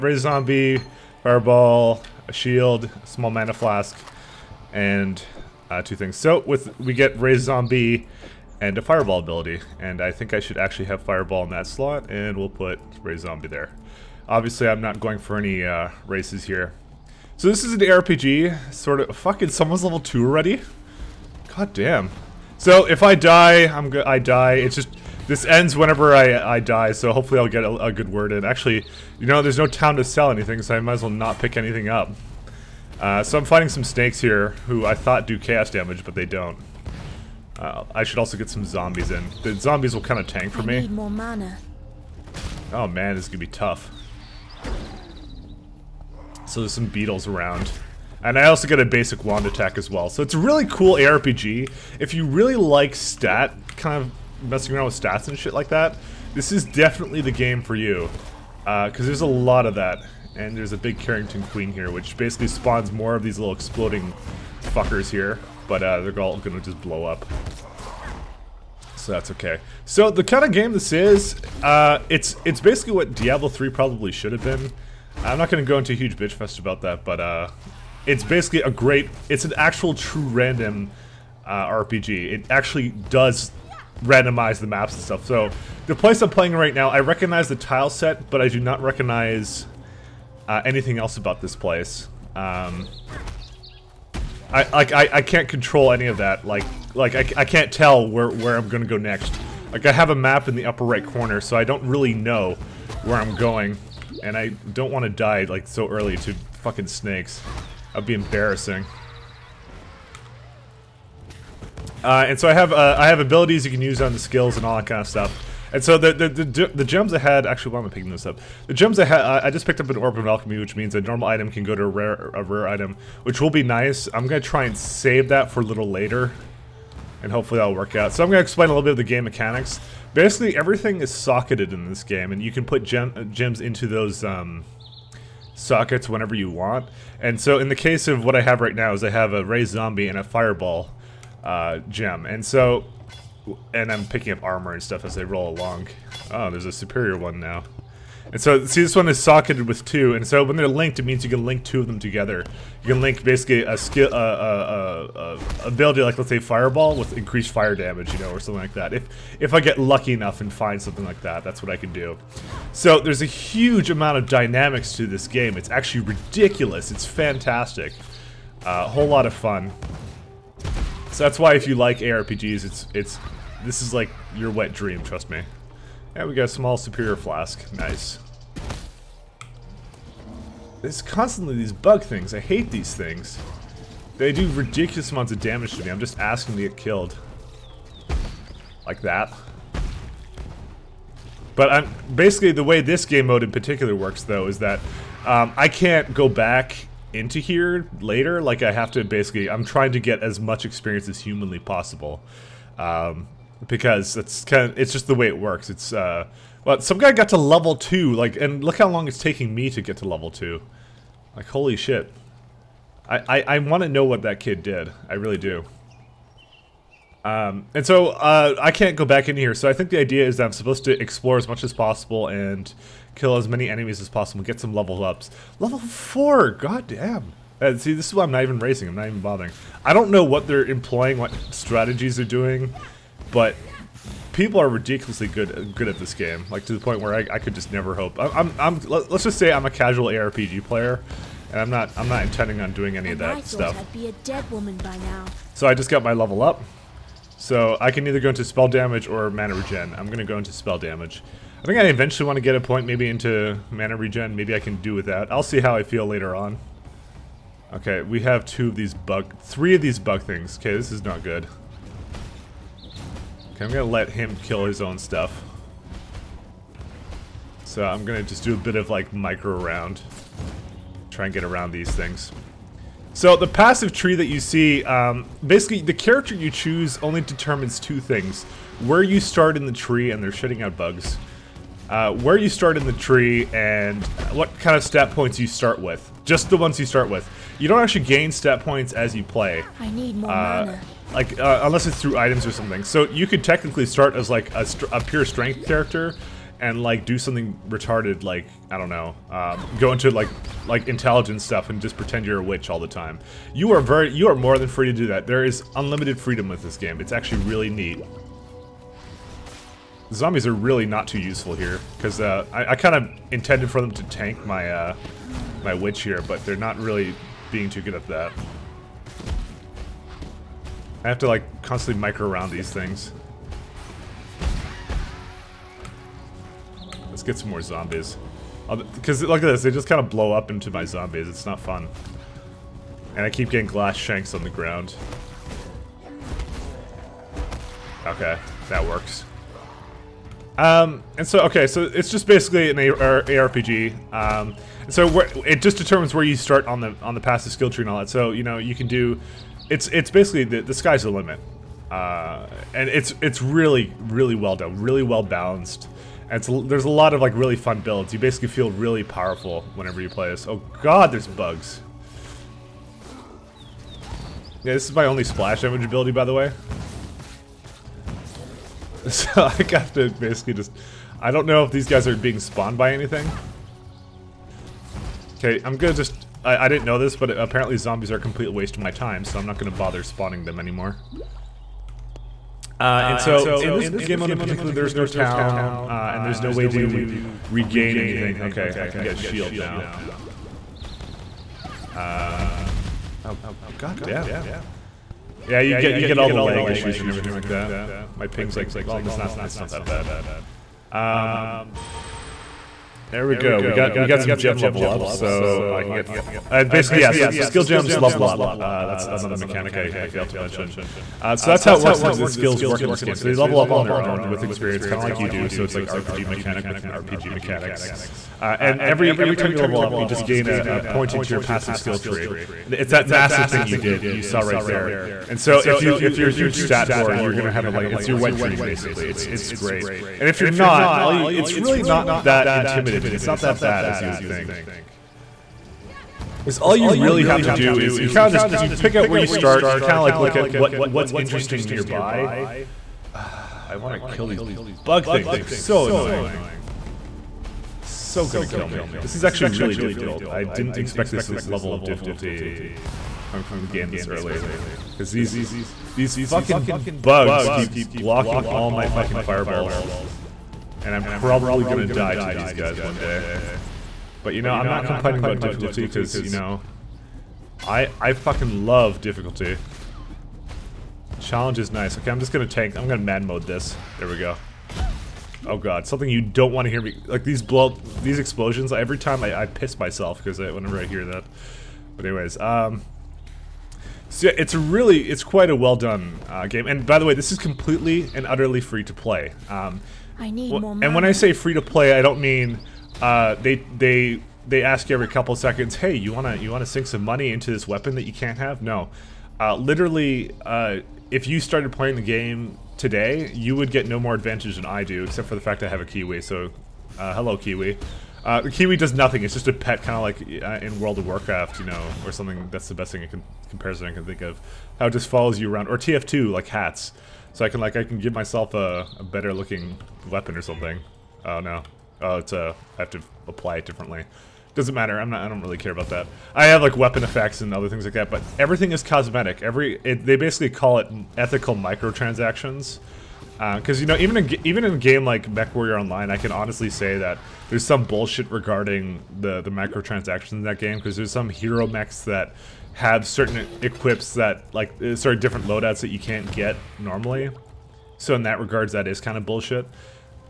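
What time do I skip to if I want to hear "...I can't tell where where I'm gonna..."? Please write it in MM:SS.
01:37.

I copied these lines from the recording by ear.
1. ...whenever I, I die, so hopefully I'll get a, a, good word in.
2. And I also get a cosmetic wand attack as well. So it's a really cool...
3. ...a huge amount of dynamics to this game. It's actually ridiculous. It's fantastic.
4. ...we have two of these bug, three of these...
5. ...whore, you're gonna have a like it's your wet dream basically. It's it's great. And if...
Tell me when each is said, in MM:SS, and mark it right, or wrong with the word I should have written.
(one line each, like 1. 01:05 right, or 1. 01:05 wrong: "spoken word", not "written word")
1. 00:25 right
2. 00:48 wrong: "basic", not "cosmetic"
3. 02:43 right
4. 04:18 right
5. 07:06 right.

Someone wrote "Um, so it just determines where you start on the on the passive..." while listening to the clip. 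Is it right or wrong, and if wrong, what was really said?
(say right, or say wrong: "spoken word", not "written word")
right.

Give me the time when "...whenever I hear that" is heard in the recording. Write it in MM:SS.
08:00.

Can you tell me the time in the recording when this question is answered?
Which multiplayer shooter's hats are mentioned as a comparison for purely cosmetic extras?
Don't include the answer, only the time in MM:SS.
08:35.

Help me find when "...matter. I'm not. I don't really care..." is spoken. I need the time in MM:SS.
08:44.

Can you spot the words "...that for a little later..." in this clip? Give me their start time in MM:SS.
02:05.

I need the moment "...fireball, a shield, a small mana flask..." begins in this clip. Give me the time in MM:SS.
00:01.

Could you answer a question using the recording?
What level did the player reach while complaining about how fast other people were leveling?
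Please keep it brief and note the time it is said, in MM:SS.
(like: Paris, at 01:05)
4, at 03:45.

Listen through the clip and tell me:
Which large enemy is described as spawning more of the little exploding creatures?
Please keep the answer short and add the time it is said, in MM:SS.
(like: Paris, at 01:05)
Carrion Queen, at 01:00.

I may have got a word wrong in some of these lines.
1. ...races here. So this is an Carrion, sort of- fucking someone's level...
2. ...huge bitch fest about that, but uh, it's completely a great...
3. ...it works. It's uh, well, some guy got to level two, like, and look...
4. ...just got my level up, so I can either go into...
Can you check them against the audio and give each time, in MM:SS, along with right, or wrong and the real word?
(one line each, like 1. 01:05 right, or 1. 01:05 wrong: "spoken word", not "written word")
1. 00:16 wrong: "RPG", not "Carrion"
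2. 01:15 wrong: "basically", not "completely"
3. 03:25 right
4. 04:05 right.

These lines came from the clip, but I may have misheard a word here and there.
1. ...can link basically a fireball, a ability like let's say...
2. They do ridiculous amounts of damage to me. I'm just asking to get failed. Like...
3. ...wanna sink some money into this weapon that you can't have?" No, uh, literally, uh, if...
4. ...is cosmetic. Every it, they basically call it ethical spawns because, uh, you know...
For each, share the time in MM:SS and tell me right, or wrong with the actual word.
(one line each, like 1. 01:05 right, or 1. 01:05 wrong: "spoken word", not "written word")
1. 02:32 wrong: "skill", not "fireball"
2. 03:04 wrong: "killed", not "failed"
3. 08:16 right
4. 08:48 wrong: "microtransactions", not "spawns".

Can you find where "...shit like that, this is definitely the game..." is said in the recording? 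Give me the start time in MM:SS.
00:55.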